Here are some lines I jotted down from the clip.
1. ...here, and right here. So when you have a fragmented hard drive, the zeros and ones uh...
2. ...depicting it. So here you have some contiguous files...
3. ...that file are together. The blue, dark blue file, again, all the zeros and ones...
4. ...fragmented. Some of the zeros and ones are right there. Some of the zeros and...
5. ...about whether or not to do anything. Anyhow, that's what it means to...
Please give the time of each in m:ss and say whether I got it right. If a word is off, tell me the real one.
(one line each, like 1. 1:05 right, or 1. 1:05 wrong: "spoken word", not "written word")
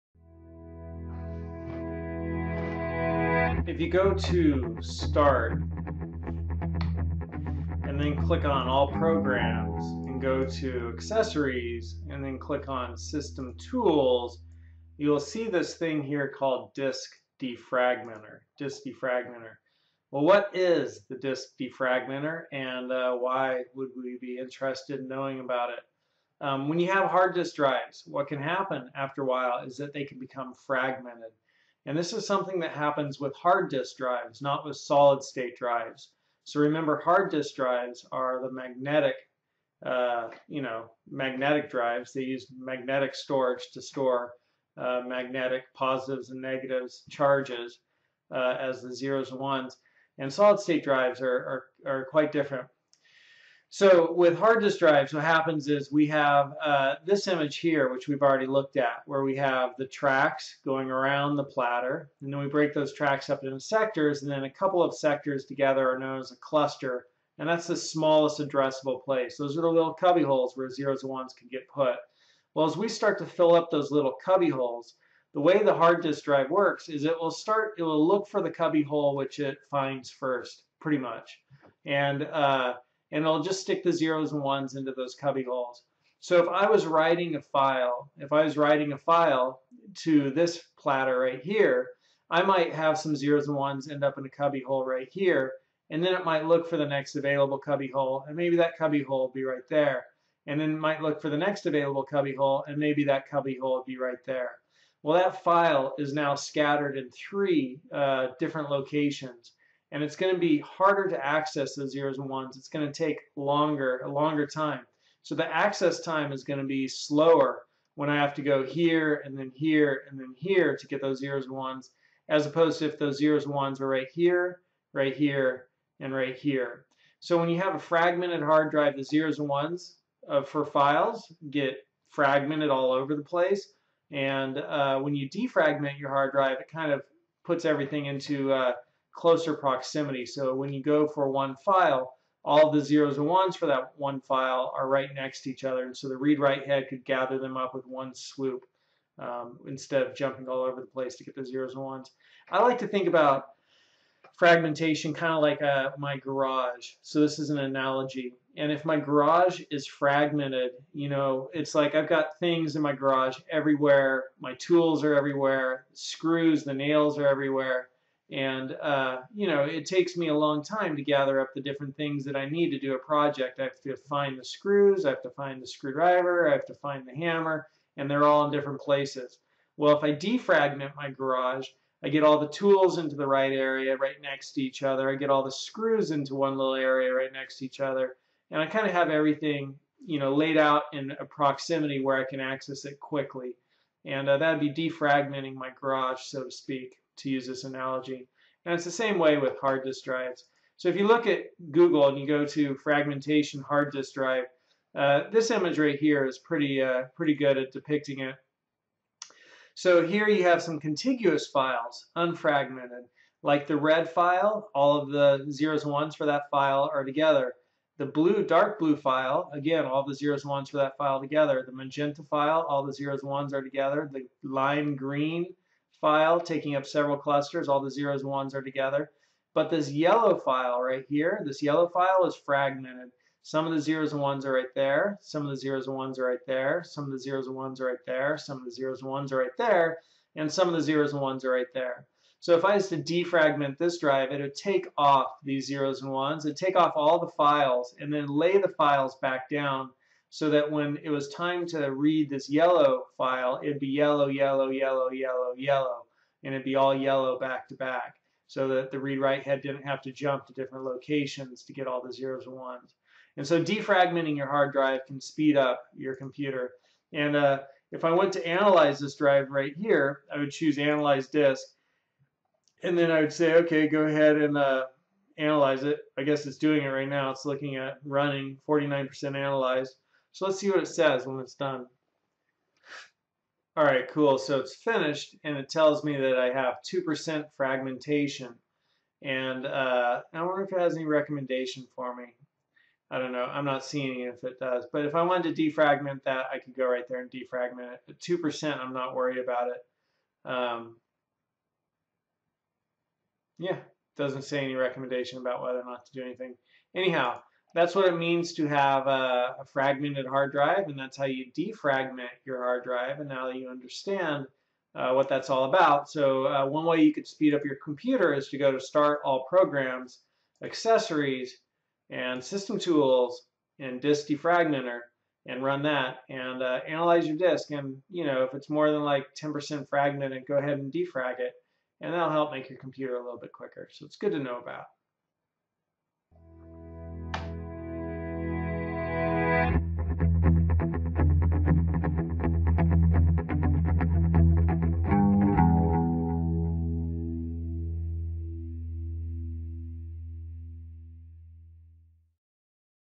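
1. 2:05 right
2. 3:27 right
3. 3:36 right
4. 3:52 right
5. 5:05 right.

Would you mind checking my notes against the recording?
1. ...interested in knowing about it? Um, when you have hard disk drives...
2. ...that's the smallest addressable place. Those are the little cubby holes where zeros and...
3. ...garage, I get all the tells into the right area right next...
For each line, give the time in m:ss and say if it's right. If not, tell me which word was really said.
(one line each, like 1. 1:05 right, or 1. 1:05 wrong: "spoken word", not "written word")
1. 0:24 right
2. 1:07 right
3. 3:01 wrong: "tools", not "tells".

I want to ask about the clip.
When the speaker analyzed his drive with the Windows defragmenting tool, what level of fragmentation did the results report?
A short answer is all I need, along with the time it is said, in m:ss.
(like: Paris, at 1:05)
2%, at 4:46.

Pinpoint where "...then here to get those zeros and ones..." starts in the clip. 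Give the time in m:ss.
2:00.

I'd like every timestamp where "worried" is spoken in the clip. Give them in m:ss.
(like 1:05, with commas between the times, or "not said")
4:59.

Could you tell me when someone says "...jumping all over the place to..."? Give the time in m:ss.
2:30.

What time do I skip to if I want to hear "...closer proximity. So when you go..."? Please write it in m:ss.
2:19.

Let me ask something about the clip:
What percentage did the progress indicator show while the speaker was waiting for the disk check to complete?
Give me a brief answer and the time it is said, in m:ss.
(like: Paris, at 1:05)
49%, at 4:38.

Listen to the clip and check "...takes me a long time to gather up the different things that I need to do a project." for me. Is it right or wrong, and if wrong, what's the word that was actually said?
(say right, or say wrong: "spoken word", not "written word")
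right.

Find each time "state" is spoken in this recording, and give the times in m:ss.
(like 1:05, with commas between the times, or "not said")
0:35, 0:50.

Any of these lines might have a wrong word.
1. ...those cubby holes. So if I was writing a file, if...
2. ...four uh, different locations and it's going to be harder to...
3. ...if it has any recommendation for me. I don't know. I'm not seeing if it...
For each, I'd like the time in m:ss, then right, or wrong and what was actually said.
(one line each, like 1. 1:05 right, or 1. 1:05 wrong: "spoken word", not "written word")
1. 1:24 right
2. 1:47 wrong: "three", not "four"
3. 4:50 right.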